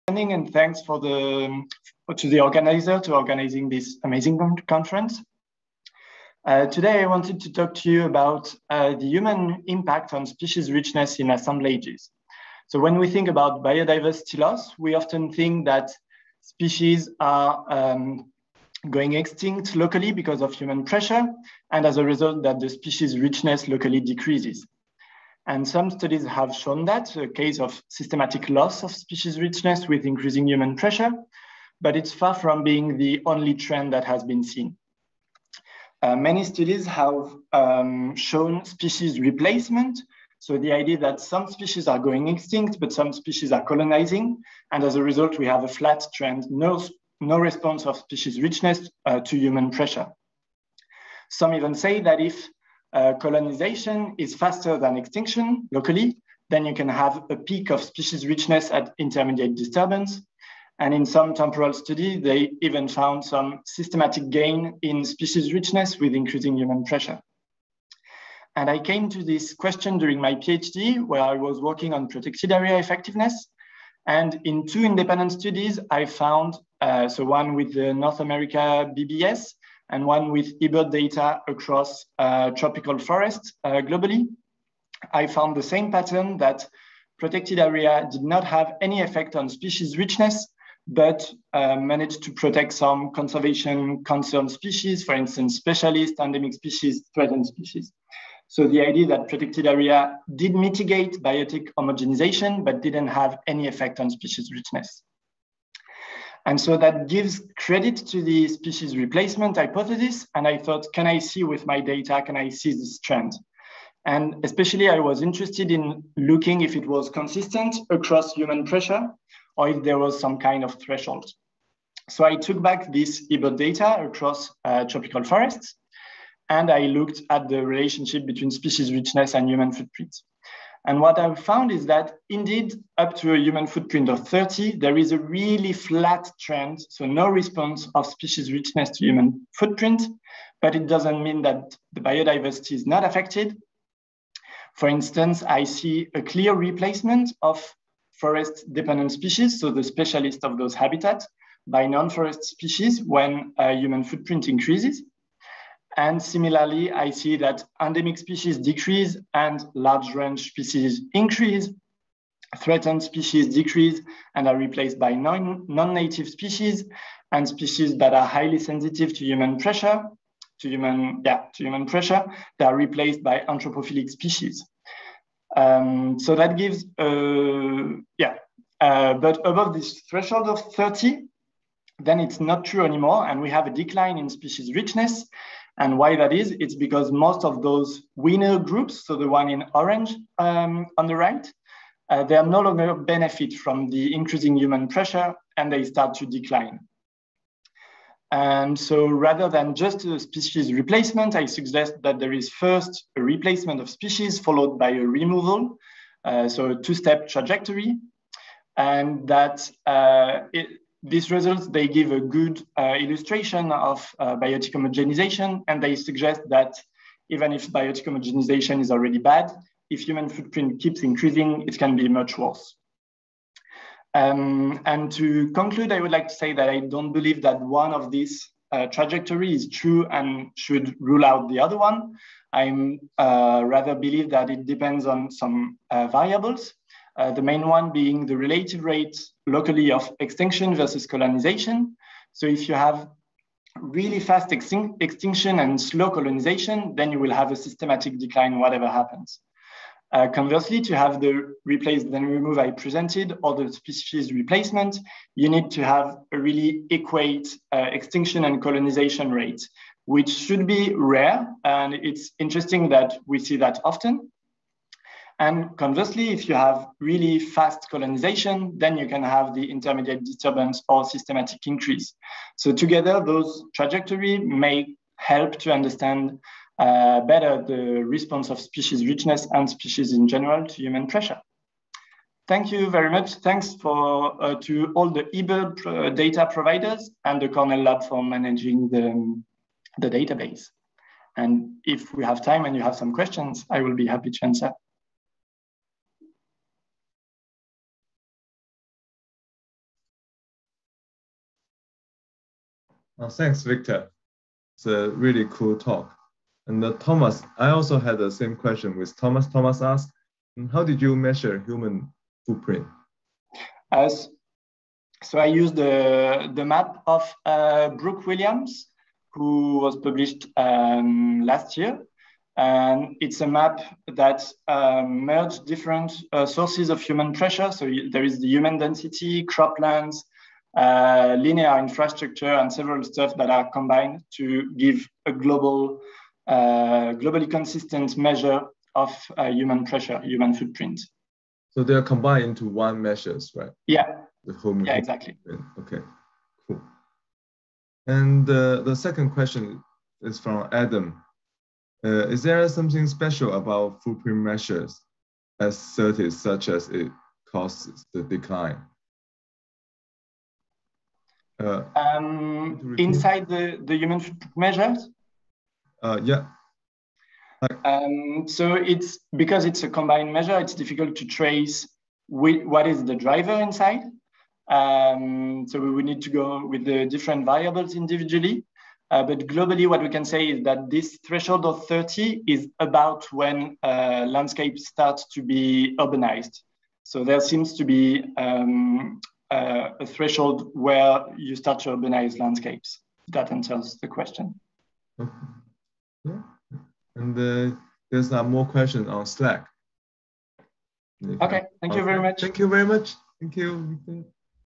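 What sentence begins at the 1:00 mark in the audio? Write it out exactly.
And in some temporal study, they even found some systematic gain in species richness with increasing human pressure.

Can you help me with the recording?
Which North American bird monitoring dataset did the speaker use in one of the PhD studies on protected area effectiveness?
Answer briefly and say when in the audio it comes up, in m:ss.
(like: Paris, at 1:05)
BBS, at 1:17.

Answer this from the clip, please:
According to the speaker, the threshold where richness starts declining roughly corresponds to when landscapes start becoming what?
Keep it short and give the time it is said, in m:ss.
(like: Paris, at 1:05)
urbanized, at 6:25.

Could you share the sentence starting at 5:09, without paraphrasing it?
Thomas asked, how did you measure human footprint?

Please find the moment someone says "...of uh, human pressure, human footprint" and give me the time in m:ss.
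5:38.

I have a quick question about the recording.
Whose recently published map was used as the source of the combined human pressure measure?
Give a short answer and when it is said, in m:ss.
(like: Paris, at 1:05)
Brooke Williams, at 5:17.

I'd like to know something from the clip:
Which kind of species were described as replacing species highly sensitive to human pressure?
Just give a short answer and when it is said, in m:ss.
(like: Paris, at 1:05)
anthropophilic species, at 2:53.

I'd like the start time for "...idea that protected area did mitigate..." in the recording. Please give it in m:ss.
1:38.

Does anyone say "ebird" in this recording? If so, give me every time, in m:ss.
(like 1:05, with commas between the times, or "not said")
1:20, 2:03, 4:45.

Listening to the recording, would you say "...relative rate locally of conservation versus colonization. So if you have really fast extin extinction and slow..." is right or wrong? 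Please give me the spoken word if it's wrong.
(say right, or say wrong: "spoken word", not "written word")
wrong: "extinction", not "conservation".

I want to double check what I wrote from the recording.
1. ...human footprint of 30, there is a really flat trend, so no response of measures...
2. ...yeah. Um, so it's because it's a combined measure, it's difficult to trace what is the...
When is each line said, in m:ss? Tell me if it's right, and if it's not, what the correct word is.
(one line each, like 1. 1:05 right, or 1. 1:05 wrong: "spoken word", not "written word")
1. 2:13 wrong: "species", not "measures"
2. 6:06 right.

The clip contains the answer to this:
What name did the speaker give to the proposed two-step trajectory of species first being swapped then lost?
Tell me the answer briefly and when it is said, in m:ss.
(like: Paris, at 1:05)
replace then remove, at 4:11.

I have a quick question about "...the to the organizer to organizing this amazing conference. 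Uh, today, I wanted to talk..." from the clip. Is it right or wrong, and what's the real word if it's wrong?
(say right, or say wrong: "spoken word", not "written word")
right.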